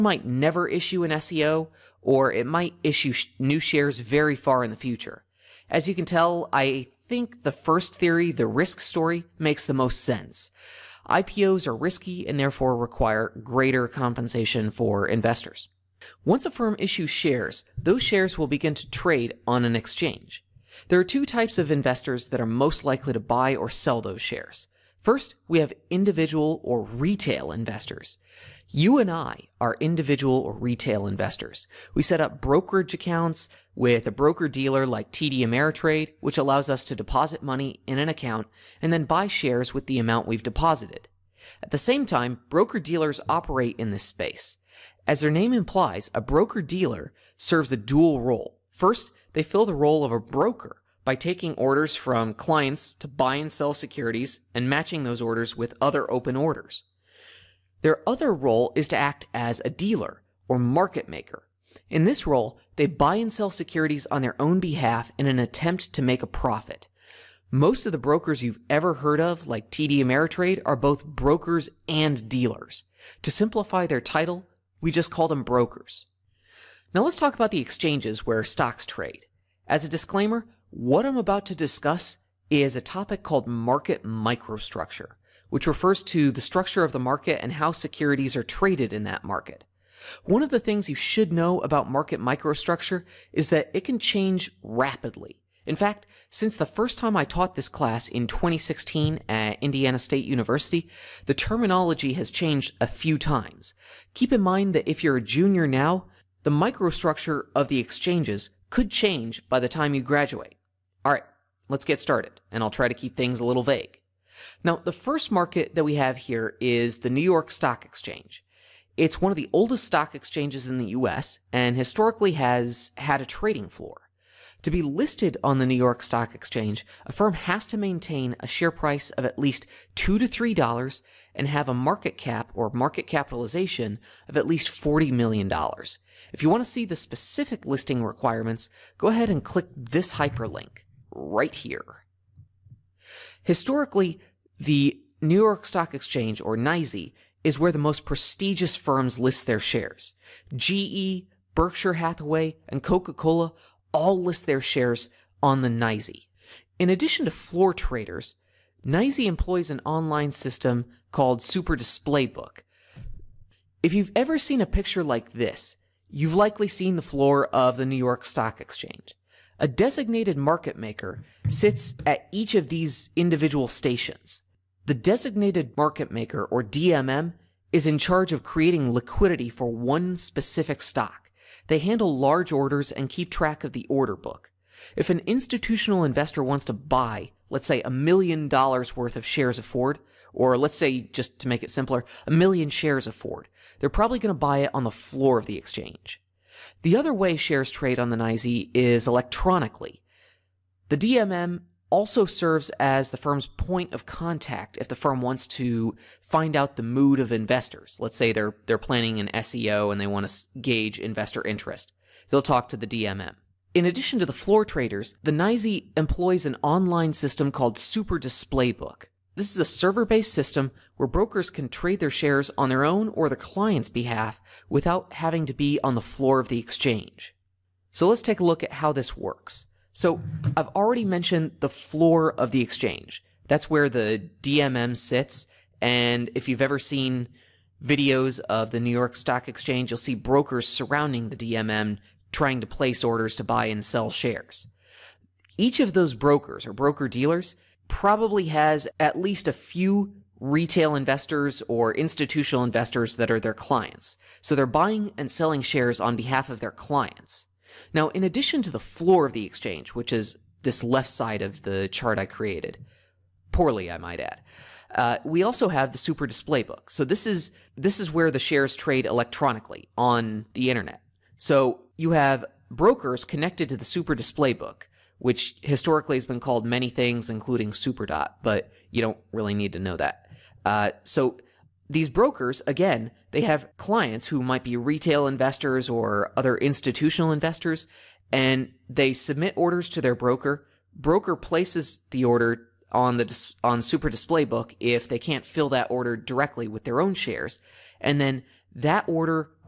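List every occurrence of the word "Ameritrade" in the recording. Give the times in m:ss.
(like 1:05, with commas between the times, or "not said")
0:35, 1:10.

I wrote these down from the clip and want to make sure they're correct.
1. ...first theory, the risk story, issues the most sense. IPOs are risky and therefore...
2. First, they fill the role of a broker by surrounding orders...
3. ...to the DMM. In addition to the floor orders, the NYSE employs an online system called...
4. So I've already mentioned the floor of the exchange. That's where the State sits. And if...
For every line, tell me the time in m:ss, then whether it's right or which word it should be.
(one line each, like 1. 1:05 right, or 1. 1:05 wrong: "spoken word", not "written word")
1. 0:07 wrong: "makes", not "issues"
2. 0:48 wrong: "taking", not "surrounding"
3. 3:32 wrong: "traders", not "orders"
4. 3:49 wrong: "DMM", not "State".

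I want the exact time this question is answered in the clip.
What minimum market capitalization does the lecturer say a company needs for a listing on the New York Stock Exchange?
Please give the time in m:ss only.
2:14.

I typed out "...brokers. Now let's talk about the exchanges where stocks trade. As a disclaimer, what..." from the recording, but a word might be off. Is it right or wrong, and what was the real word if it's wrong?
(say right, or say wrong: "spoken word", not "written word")
right.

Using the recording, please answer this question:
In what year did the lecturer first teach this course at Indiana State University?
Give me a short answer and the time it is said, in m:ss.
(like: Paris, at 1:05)
2016, at 1:38.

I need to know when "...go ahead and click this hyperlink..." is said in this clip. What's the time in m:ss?
2:18.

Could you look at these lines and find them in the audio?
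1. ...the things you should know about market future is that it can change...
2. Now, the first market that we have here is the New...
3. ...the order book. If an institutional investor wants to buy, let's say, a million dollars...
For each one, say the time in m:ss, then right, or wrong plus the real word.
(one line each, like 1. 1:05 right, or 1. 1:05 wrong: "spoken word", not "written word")
1. 1:30 wrong: "microstructure", not "future"
2. 1:54 right
3. 3:03 right.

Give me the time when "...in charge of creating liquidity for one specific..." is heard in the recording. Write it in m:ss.
2:57.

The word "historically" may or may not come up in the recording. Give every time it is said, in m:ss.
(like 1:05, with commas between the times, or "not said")
2:01, 2:23, 4:35.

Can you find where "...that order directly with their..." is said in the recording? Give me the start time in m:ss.
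4:55.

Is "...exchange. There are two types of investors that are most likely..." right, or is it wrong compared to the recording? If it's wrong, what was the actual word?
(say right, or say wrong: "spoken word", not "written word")
right.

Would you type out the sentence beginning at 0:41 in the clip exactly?
At the same time, broker dealers operate in this space.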